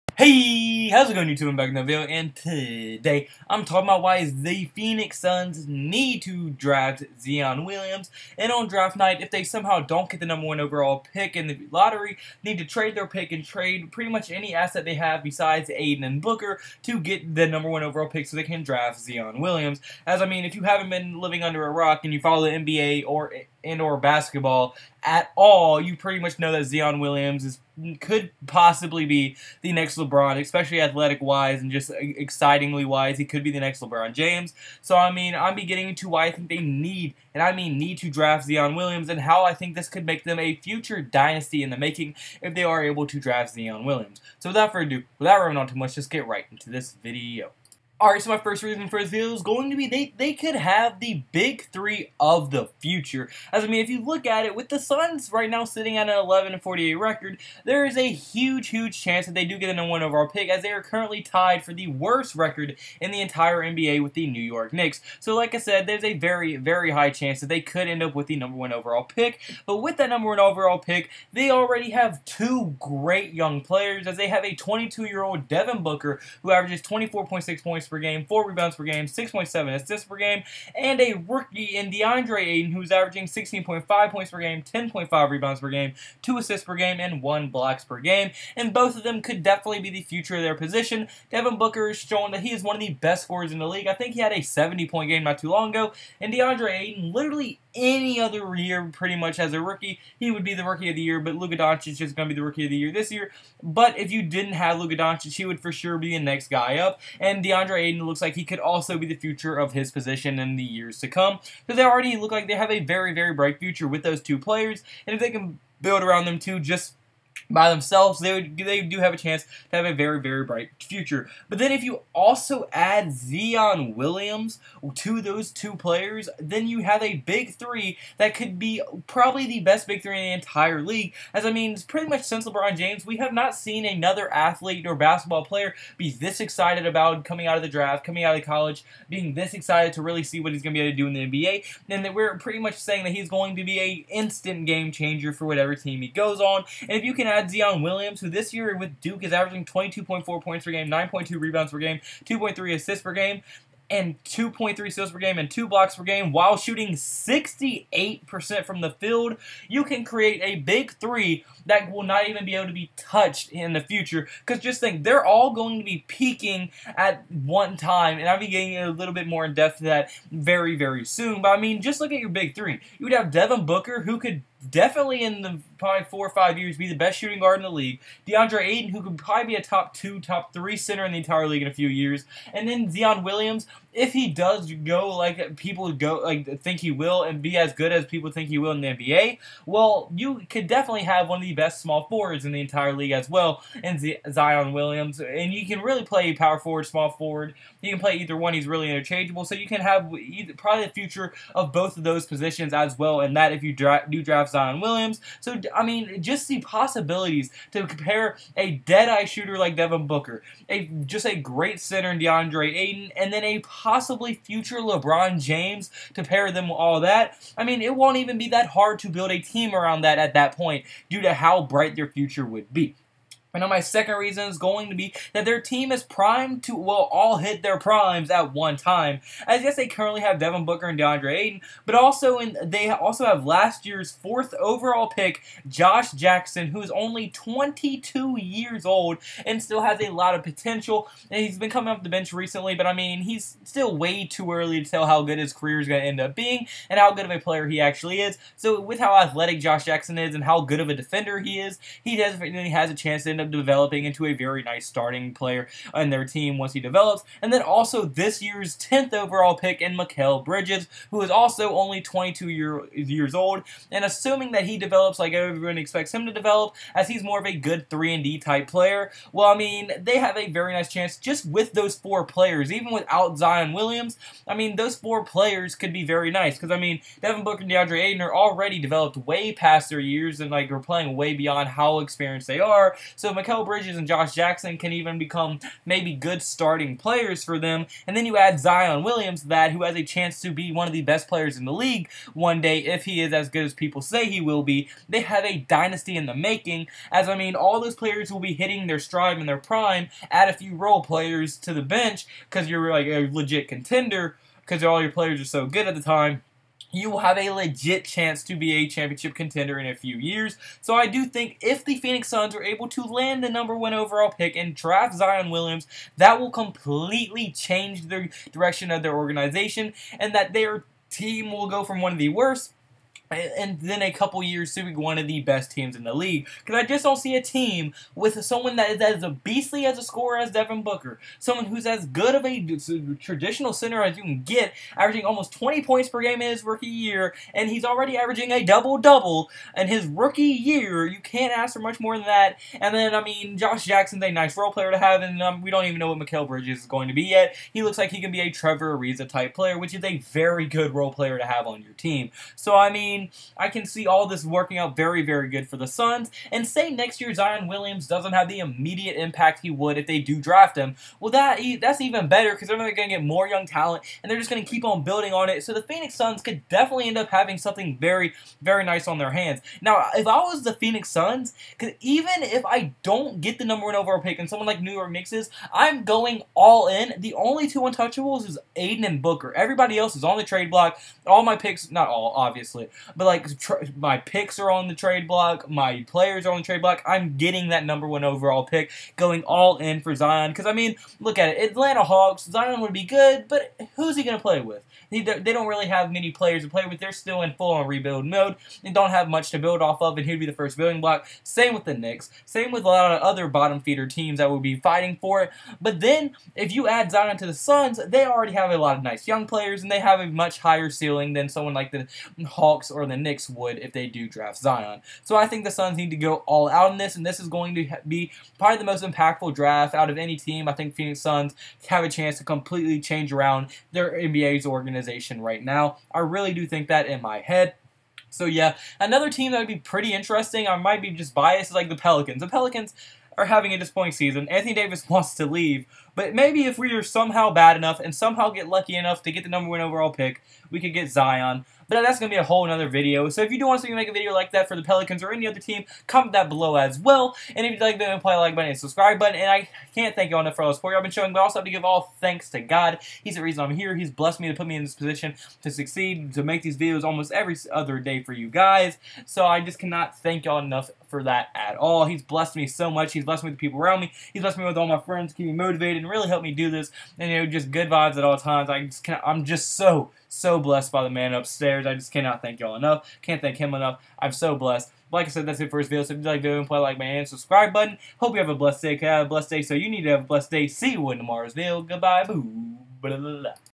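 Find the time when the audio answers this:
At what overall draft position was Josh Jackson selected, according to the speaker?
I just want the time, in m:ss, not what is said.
3:54.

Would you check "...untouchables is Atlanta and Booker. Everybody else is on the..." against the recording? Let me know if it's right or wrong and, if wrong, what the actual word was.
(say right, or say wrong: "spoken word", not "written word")
wrong: "Ayton", not "Atlanta".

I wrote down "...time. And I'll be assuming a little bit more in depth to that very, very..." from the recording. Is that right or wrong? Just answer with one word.
wrong.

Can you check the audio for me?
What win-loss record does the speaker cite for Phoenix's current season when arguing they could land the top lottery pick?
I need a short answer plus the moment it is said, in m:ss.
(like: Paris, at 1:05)
11-48, at 0:56.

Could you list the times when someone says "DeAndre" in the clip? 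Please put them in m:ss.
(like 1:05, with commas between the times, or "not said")
1:21, 1:36, 1:47, 2:58, 3:32, 3:50, 4:37.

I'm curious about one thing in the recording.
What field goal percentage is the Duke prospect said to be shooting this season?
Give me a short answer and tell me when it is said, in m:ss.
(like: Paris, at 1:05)
68%, at 2:36.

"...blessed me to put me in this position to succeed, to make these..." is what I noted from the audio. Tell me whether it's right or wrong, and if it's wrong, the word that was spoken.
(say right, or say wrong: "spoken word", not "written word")
right.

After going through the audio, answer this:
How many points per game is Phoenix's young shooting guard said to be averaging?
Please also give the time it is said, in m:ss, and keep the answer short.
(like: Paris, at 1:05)
24.6, at 1:16.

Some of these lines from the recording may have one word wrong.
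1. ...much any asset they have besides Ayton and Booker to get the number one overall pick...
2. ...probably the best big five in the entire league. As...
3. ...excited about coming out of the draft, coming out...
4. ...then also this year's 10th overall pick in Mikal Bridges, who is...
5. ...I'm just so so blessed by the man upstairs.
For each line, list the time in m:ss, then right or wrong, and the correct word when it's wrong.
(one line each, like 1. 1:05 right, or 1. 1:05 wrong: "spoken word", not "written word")
1. 0:14 right
2. 2:09 wrong: "three", not "five"
3. 2:16 right
4. 4:17 right
5. 7:49 right.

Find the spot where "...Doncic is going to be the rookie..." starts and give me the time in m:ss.
1:41.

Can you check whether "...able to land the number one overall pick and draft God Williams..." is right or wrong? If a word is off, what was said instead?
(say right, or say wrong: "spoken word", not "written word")
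wrong: "Zion", not "God".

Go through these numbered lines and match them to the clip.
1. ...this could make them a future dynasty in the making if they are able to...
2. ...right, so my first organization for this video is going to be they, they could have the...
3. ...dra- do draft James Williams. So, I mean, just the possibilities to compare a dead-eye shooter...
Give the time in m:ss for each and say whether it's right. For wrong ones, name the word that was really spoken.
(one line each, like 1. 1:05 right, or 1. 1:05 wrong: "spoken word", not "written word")
1. 0:39 right
2. 0:48 wrong: "reason", not "organization"
3. 3:23 wrong: "Zion", not "James".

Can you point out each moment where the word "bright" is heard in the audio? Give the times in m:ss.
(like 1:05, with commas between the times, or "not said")
1:53, 2:00, 3:41.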